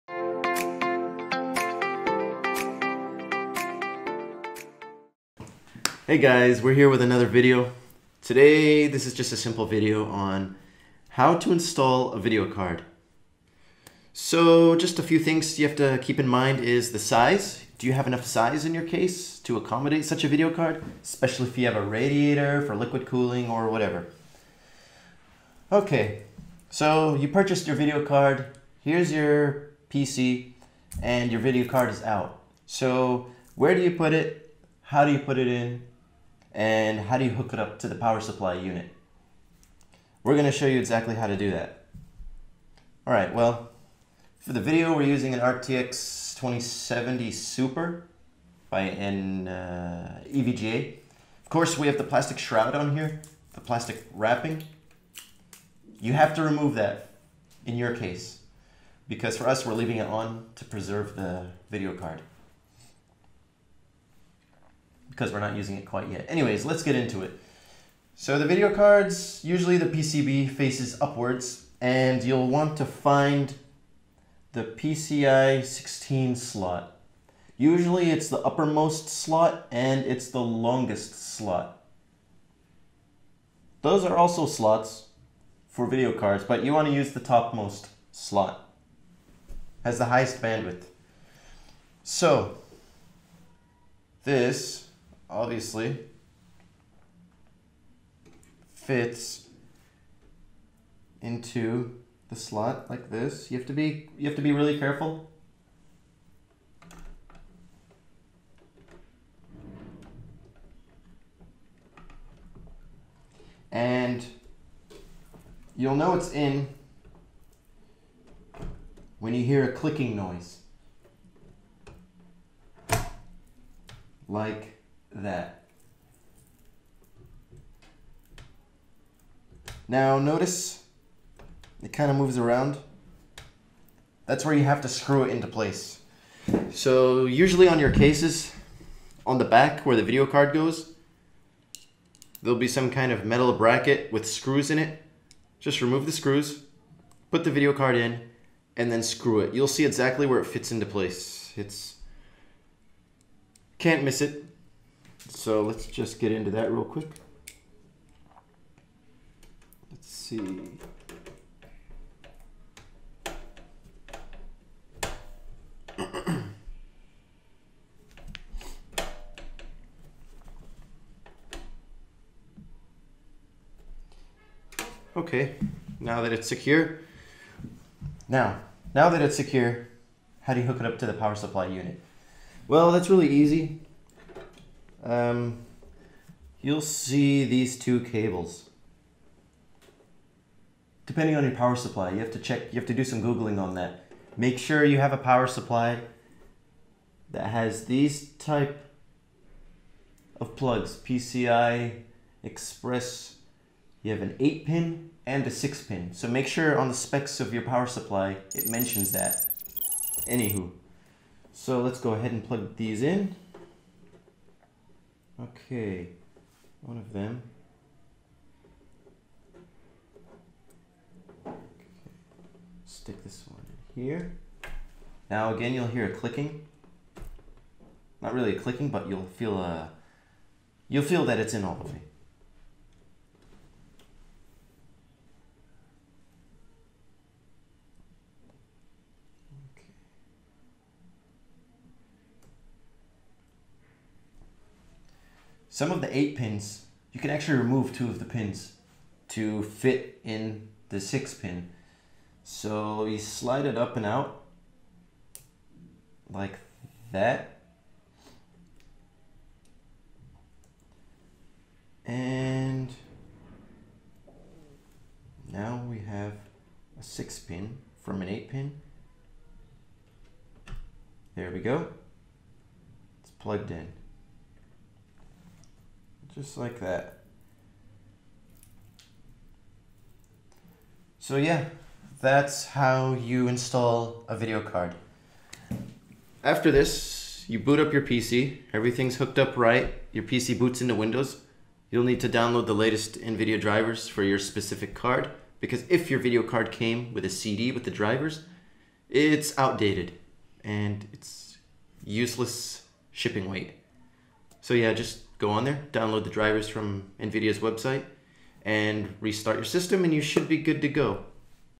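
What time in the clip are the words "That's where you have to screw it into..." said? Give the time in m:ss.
2:14.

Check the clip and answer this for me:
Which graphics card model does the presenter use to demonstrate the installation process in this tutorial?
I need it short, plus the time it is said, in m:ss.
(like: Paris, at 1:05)
RTX 2070 Super, at 0:45.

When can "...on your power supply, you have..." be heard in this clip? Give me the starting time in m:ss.
3:11.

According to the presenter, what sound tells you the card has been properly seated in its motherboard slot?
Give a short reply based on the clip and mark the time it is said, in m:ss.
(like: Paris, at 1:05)
clicking noise, at 1:59.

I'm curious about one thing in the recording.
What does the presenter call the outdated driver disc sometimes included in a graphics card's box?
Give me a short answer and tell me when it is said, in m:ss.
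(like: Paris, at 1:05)
useless shipping weight, at 5:02.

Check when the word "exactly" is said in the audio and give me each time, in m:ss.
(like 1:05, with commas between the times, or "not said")
0:40, 2:29.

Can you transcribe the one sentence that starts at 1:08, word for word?
So the video cards, usually the PCB faces upwards and you'll want to find the PCI 16 slot.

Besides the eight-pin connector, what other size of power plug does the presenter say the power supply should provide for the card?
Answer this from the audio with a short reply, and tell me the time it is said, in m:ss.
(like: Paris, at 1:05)
6 pin, at 3:25.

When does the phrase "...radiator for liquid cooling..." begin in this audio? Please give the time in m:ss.
0:21.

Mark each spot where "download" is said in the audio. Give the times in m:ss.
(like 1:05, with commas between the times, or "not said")
4:52, 5:05.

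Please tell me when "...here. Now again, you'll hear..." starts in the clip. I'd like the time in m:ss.
3:44.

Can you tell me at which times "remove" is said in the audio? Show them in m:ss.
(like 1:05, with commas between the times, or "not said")
0:56, 2:25, 4:07.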